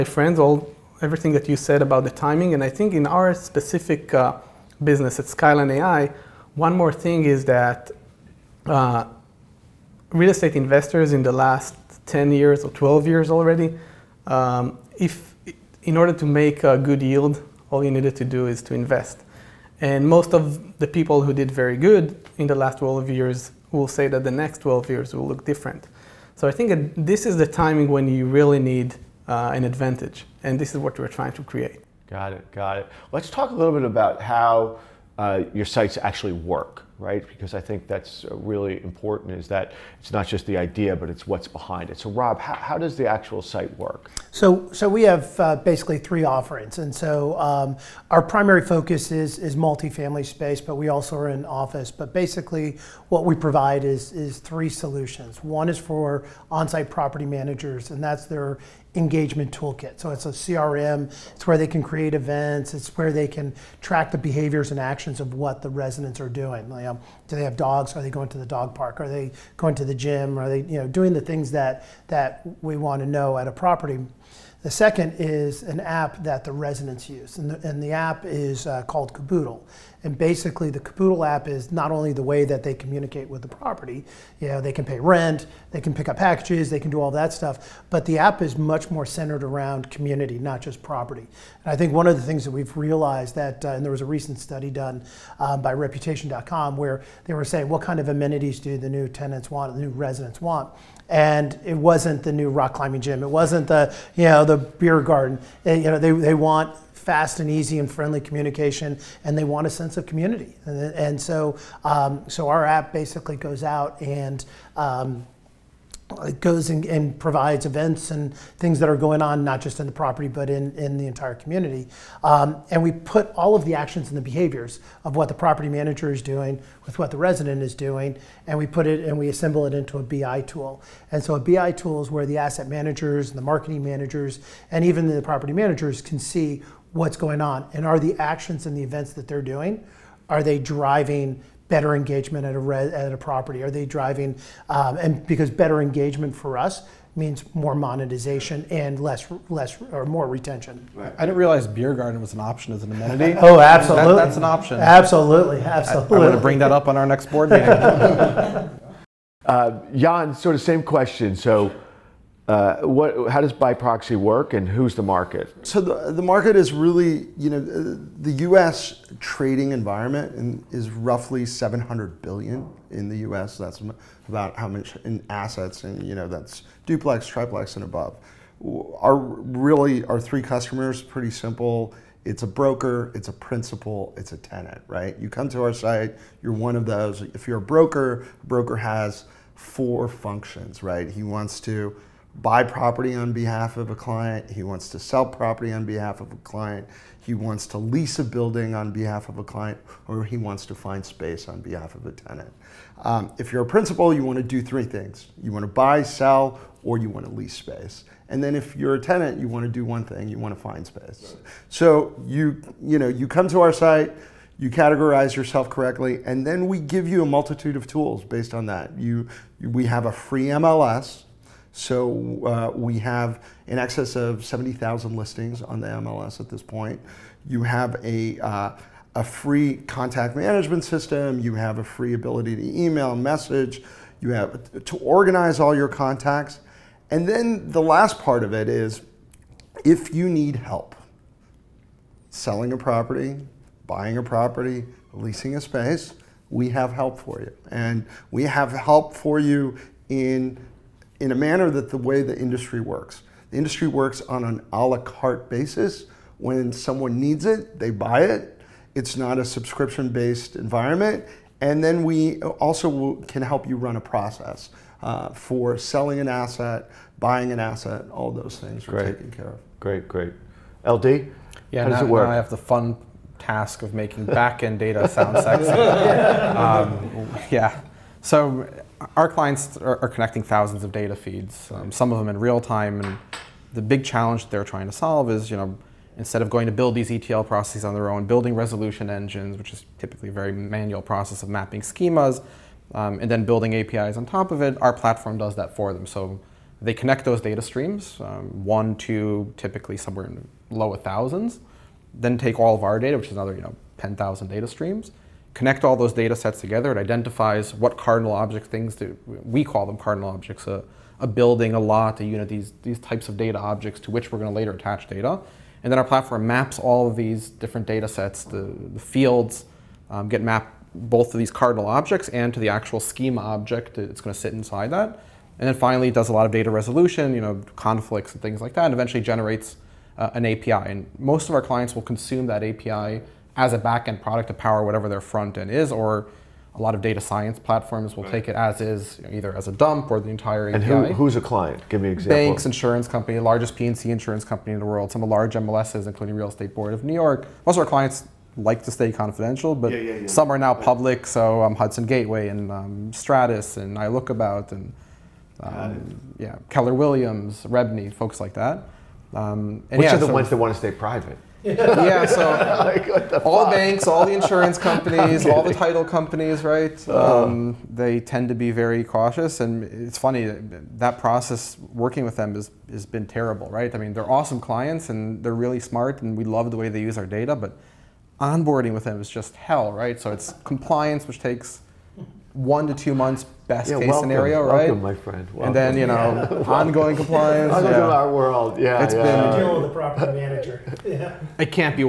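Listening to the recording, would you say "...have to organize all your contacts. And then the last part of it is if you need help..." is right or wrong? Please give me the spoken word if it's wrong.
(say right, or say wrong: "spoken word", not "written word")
right.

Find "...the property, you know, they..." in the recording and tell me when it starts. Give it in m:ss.
1:23.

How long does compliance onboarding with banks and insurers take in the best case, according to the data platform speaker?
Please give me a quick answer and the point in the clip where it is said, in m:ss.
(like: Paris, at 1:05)
one to two months, at 6:22.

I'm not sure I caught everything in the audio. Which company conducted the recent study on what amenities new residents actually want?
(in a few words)
Reputation.com.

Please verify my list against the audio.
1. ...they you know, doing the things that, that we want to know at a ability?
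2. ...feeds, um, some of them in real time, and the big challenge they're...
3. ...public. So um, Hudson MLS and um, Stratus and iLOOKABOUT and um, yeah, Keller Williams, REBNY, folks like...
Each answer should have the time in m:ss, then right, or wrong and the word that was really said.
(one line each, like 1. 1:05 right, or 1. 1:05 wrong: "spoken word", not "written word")
1. 1:10 wrong: "property", not "ability"
2. 4:41 right
3. 5:50 wrong: "Gateway", not "MLS".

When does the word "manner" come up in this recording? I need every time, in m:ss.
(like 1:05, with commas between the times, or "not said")
4:11.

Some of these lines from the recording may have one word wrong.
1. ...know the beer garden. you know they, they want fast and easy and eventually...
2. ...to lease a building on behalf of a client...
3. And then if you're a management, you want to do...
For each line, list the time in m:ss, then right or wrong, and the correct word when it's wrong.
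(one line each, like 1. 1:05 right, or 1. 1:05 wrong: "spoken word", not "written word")
1. 1:44 wrong: "friendly", not "eventually"
2. 3:17 right
3. 3:28 wrong: "tenant", not "management".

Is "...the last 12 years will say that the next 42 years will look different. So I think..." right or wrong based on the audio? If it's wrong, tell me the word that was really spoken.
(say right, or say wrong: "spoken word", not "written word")
wrong: "12", not "42".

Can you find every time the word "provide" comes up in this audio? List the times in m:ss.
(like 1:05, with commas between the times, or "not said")
0:53, 1:57.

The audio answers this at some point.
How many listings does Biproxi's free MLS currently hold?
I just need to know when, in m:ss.
3:44.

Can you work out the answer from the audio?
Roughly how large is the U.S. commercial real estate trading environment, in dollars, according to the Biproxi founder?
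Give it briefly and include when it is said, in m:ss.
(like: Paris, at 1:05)
700 billion, at 2:51.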